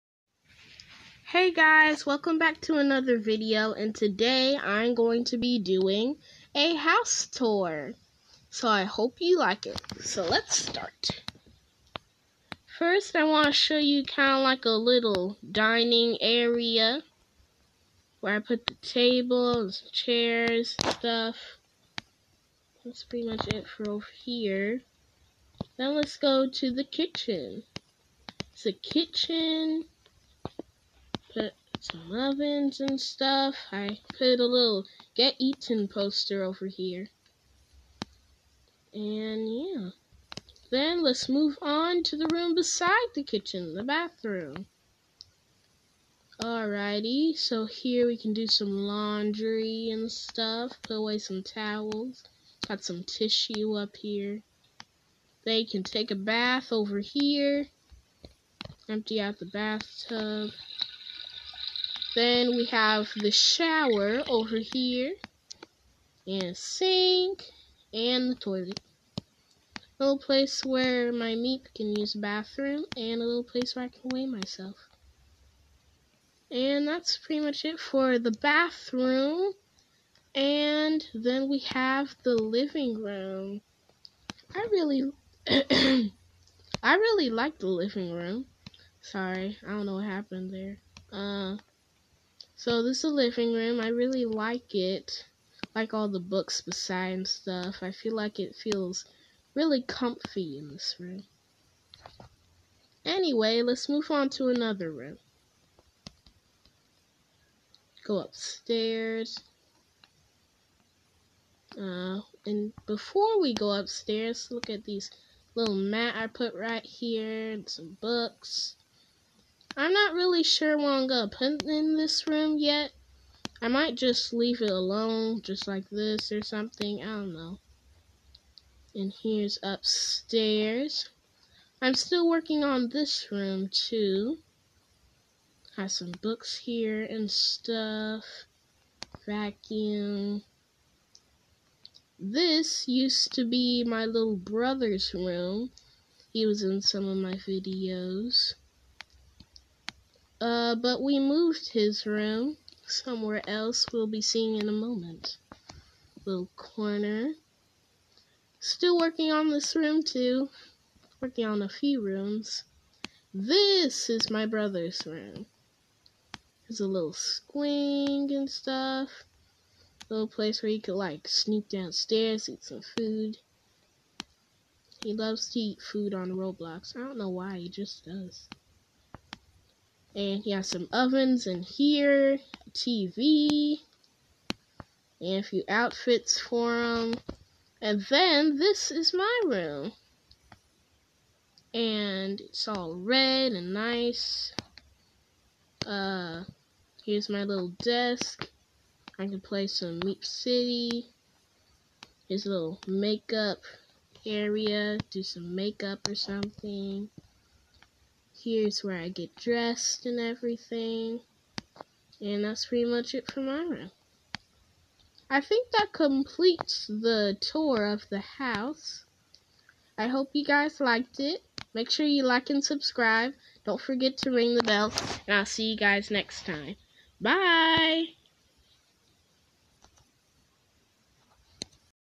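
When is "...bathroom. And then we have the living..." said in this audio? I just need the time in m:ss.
1:18.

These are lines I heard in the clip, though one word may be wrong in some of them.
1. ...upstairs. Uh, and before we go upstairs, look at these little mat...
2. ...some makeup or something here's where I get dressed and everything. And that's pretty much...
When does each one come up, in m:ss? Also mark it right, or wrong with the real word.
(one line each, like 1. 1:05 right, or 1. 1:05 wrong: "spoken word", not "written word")
1. 1:48 right
2. 3:25 right.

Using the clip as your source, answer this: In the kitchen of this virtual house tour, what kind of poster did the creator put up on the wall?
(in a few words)
Get Eaten poster.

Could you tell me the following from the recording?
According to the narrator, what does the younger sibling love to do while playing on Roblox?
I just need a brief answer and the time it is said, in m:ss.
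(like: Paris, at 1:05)
Eat food, at 2:55.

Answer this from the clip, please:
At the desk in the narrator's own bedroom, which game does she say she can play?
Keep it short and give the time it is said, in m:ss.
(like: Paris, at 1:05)
Meep City, at 3:20.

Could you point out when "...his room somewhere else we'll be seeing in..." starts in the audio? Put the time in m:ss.
2:31.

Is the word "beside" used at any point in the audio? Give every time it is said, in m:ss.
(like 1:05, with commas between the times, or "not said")
0:42, 1:36.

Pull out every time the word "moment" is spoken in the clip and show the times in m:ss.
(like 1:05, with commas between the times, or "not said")
2:34.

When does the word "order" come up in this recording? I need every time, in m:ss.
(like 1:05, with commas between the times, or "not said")
not said.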